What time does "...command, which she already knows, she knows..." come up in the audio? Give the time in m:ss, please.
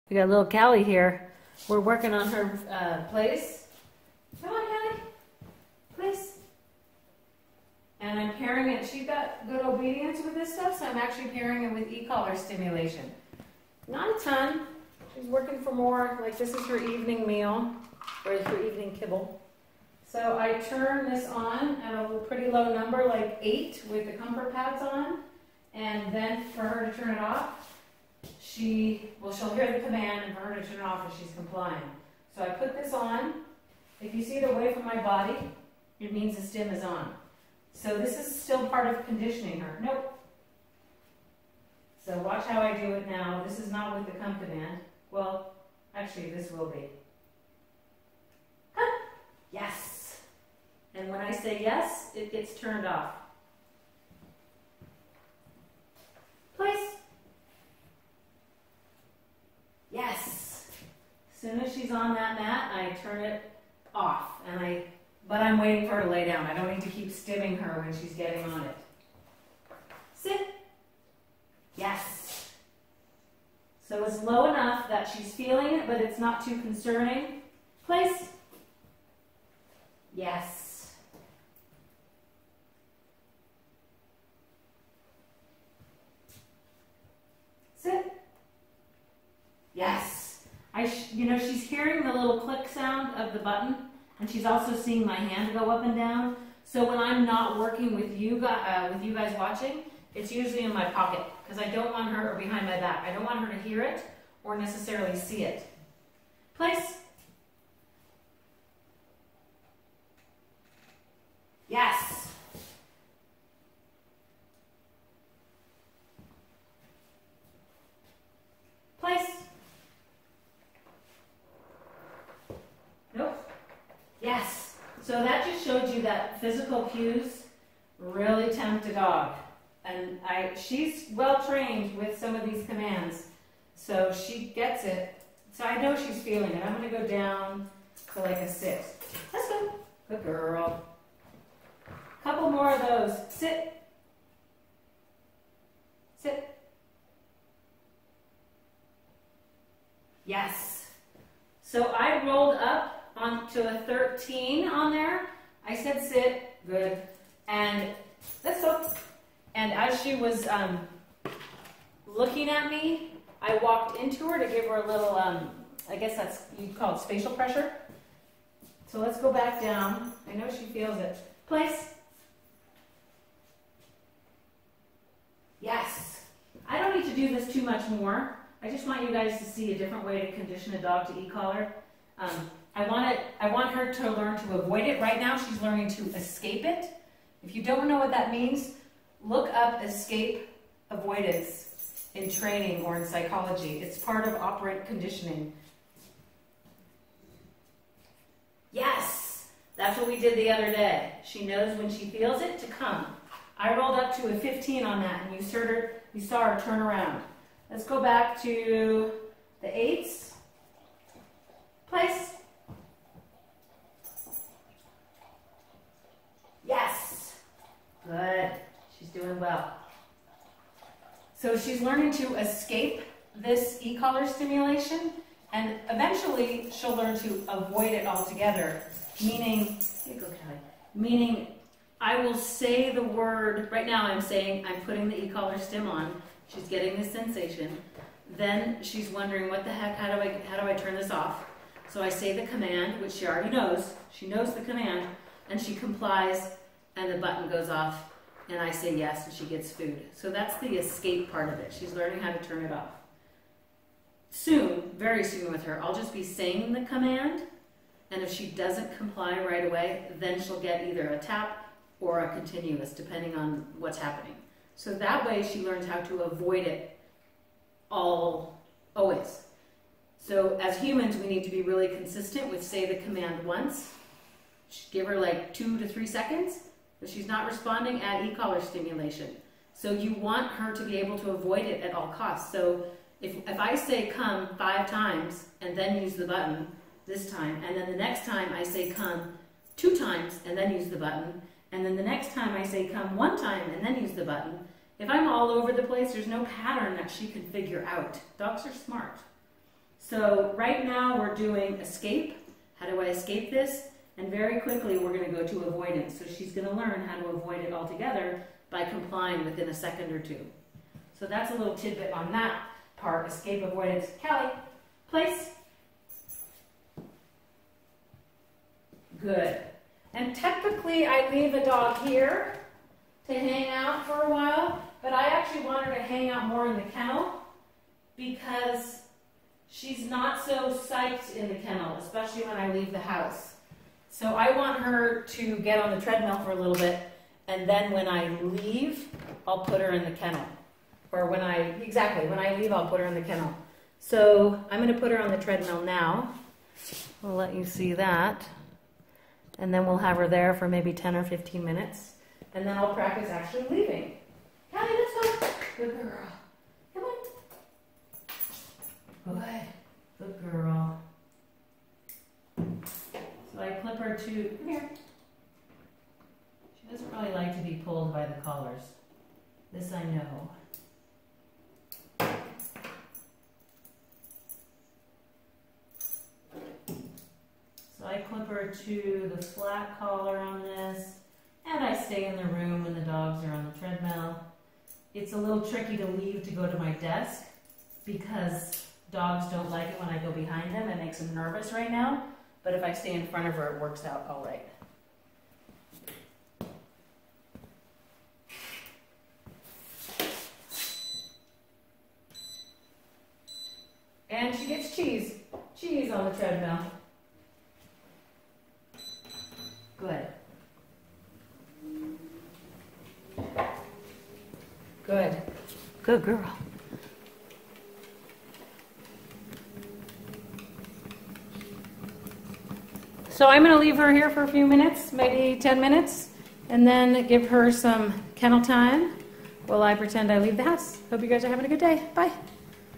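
4:02.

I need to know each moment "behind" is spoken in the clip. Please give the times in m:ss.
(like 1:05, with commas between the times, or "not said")
1:42, 6:30.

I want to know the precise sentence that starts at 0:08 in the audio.
She has got good obedience with this stuff, so I'm actually pairing it with e-collar stimulation.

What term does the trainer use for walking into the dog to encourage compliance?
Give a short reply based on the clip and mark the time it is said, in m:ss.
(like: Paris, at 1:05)
spatial pressure, at 2:47.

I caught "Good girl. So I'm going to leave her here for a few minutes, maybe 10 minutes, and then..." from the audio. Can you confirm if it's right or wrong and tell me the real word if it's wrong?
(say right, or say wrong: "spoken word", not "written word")
right.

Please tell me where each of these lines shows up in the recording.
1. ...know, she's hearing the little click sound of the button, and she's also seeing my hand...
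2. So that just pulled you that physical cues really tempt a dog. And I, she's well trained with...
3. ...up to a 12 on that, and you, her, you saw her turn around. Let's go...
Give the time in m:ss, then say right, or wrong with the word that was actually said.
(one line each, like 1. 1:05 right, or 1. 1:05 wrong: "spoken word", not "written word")
1. 1:31 right
2. 2:05 wrong: "showed", not "pulled"
3. 3:23 wrong: "15", not "12".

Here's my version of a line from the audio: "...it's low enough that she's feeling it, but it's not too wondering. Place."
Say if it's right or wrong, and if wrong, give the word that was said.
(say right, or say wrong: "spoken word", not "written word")
wrong: "concerning", not "wondering".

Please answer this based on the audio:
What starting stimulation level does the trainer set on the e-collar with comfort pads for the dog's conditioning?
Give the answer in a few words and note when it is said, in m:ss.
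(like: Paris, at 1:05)
8, at 0:23.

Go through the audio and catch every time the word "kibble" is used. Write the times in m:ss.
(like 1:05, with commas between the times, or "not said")
0:18.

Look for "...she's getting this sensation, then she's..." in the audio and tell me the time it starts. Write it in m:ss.
3:56.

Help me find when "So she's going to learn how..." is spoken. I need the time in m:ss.
5:06.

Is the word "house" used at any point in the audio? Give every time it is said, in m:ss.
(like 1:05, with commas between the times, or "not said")
5:32, 7:10.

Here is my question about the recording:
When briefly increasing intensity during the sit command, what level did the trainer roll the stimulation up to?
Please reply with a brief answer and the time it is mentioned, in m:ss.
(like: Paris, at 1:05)
13, at 2:33.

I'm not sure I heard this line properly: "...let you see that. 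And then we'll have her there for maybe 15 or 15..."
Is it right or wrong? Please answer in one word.
wrong.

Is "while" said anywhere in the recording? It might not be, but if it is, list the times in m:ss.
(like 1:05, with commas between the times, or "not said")
5:24, 7:09.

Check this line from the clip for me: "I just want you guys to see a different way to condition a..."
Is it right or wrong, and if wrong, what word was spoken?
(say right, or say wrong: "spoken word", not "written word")
right.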